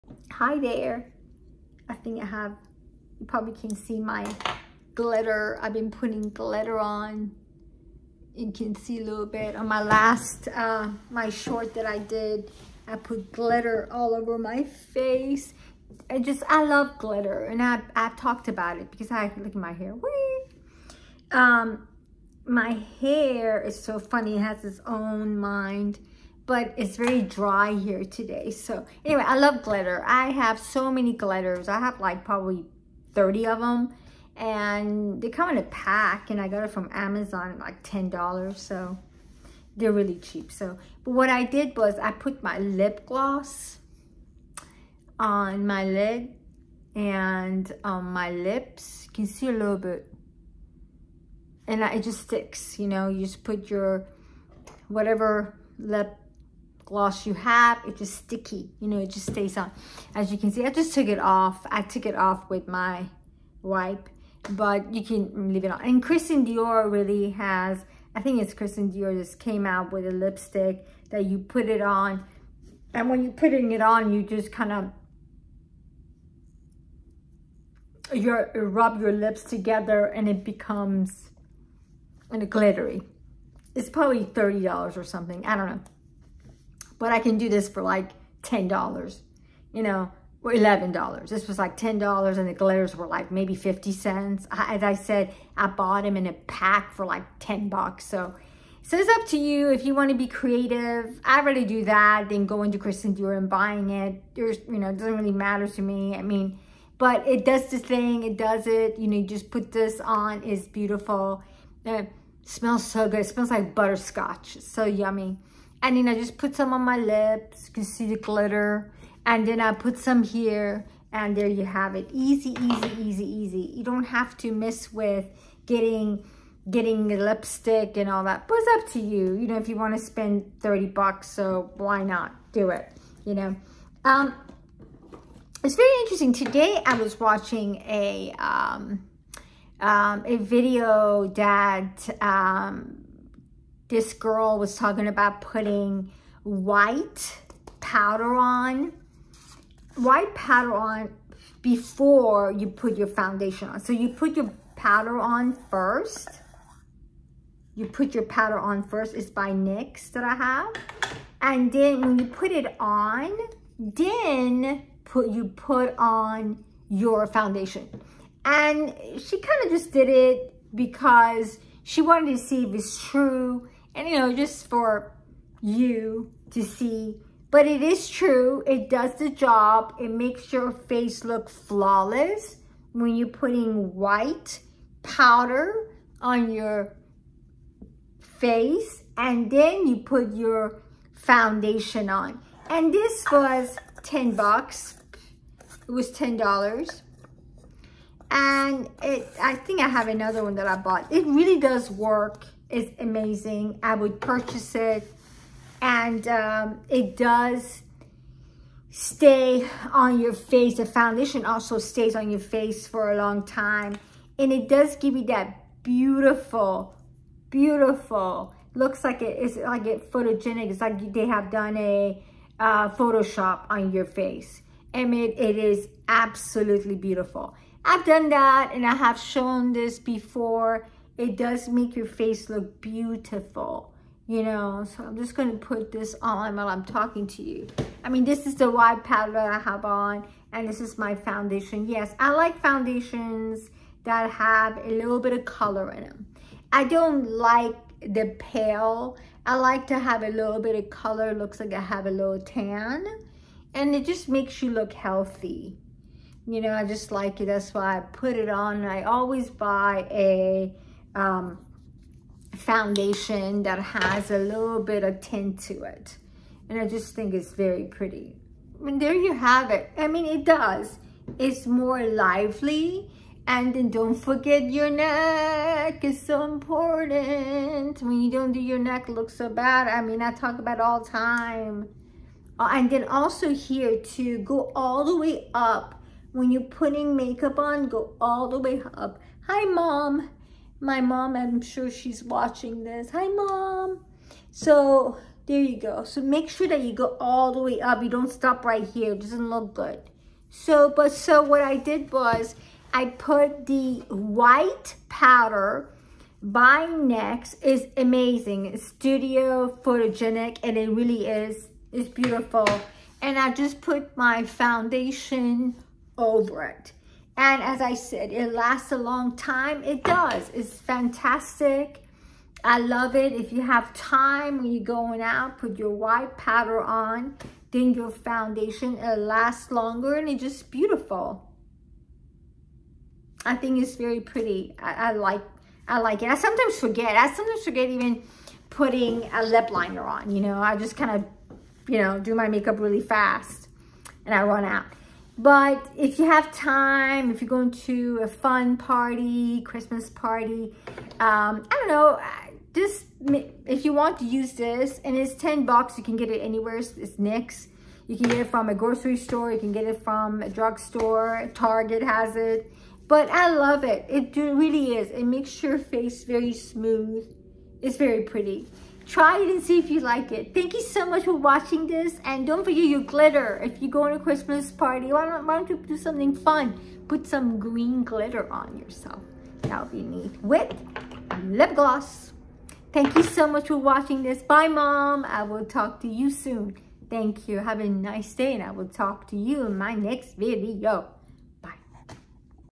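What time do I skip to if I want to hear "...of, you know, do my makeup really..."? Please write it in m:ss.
5:41.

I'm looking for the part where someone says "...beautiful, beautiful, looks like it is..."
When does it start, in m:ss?
3:35.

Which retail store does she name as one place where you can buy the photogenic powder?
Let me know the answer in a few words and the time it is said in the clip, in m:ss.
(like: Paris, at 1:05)
Target, at 6:01.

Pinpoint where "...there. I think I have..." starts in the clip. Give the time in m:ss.
0:00.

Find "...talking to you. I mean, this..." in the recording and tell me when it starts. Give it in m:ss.
3:56.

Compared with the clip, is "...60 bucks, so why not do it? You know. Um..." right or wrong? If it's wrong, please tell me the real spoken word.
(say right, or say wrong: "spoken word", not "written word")
wrong: "30", not "60".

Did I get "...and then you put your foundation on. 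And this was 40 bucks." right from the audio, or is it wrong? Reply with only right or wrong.
wrong.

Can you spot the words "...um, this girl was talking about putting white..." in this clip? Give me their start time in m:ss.
2:22.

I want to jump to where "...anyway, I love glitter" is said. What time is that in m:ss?
0:29.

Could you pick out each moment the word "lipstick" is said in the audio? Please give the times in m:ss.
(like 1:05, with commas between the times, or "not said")
1:10, 2:07.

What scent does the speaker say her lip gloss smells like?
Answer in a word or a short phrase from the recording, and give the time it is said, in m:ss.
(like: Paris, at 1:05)
Butterscotch, at 1:53.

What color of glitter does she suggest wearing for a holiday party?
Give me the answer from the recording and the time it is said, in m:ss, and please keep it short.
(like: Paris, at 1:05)
Green, at 6:17.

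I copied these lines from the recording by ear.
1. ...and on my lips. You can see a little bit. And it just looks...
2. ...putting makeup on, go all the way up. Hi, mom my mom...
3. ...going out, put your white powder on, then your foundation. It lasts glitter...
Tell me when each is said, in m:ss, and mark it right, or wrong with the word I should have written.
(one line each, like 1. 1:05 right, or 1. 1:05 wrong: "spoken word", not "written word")
1. 0:46 wrong: "sticks", not "looks"
2. 4:46 right
3. 5:24 wrong: "longer", not "glitter".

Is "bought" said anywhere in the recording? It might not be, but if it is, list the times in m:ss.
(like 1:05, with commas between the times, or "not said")
1:35, 3:20.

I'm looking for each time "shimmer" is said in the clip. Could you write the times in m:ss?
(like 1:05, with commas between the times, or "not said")
not said.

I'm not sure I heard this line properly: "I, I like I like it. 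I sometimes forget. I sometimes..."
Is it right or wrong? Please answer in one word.
right.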